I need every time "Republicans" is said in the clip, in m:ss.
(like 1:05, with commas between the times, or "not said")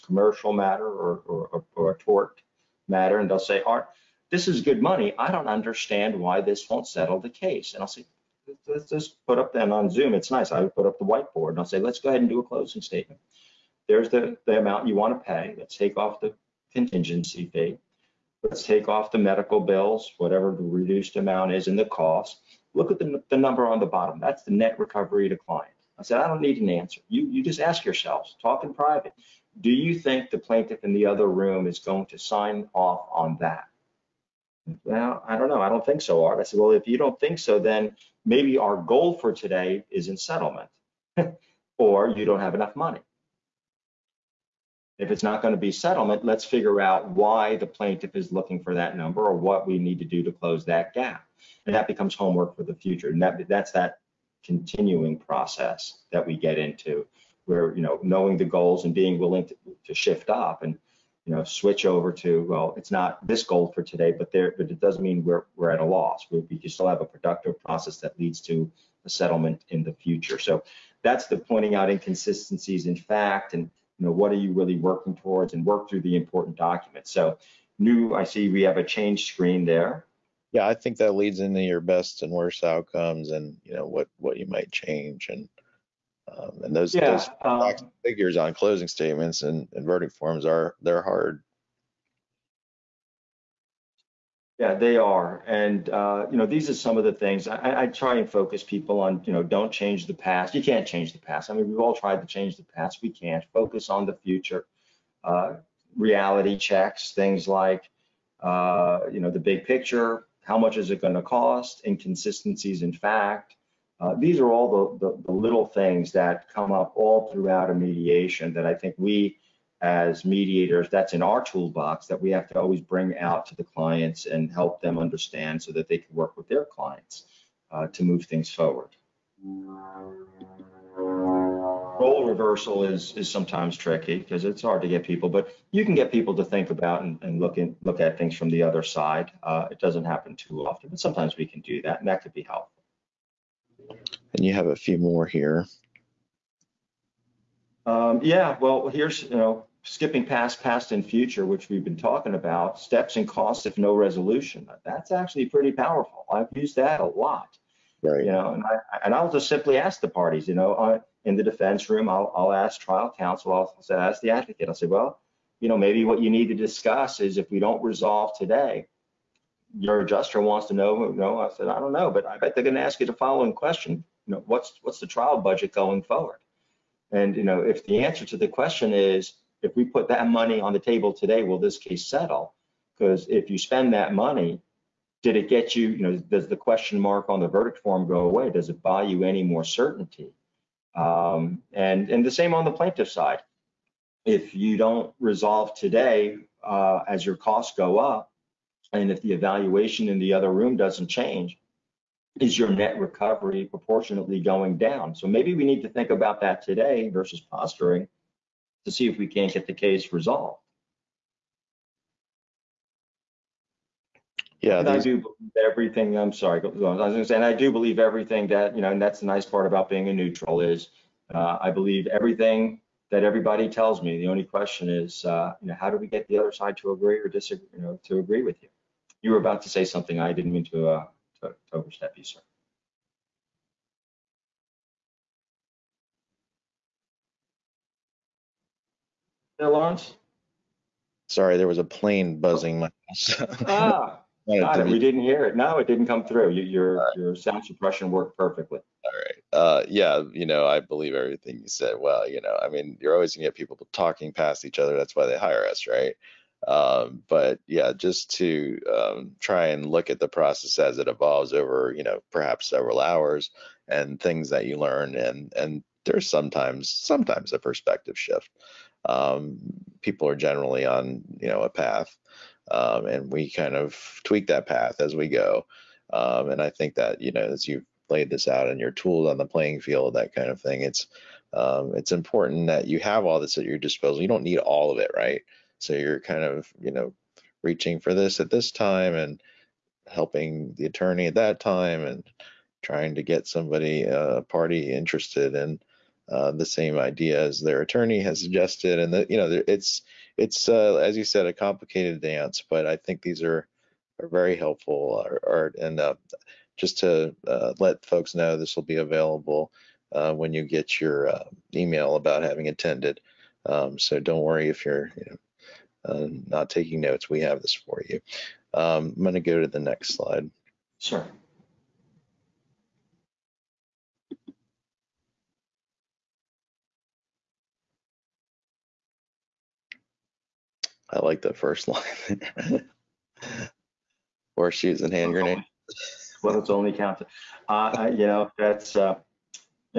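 not said.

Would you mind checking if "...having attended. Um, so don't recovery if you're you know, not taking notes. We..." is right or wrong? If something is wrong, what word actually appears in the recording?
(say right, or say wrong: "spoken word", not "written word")
wrong: "worry", not "recovery".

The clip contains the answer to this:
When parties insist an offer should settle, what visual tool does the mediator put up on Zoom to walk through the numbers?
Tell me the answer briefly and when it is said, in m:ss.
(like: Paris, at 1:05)
whiteboard, at 0:11.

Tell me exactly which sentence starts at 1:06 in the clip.
We, we can still have a productive process that leads to a settlement in the future.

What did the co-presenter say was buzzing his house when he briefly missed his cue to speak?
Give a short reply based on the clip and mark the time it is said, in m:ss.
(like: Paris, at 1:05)
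a plane, at 4:01.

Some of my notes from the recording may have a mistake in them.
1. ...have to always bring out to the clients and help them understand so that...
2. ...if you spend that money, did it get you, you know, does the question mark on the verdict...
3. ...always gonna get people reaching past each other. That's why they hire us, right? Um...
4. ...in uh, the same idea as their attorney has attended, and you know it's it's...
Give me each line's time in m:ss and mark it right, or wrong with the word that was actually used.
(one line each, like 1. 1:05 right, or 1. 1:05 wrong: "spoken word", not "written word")
1. 2:02 right
2. 3:03 right
3. 4:13 wrong: "talking", not "reaching"
4. 4:55 wrong: "suggested", not "attended".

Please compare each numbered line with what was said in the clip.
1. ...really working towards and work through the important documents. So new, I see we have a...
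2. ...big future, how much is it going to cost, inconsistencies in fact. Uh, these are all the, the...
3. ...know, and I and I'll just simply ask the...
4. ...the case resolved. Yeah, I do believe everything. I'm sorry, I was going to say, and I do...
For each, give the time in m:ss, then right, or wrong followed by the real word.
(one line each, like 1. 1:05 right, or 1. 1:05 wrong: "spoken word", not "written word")
1. 1:14 right
2. 1:49 wrong: "picture", not "future"
3. 2:38 right
4. 3:29 right.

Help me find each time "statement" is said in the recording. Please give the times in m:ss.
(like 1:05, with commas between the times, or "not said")
0:12, 1:28.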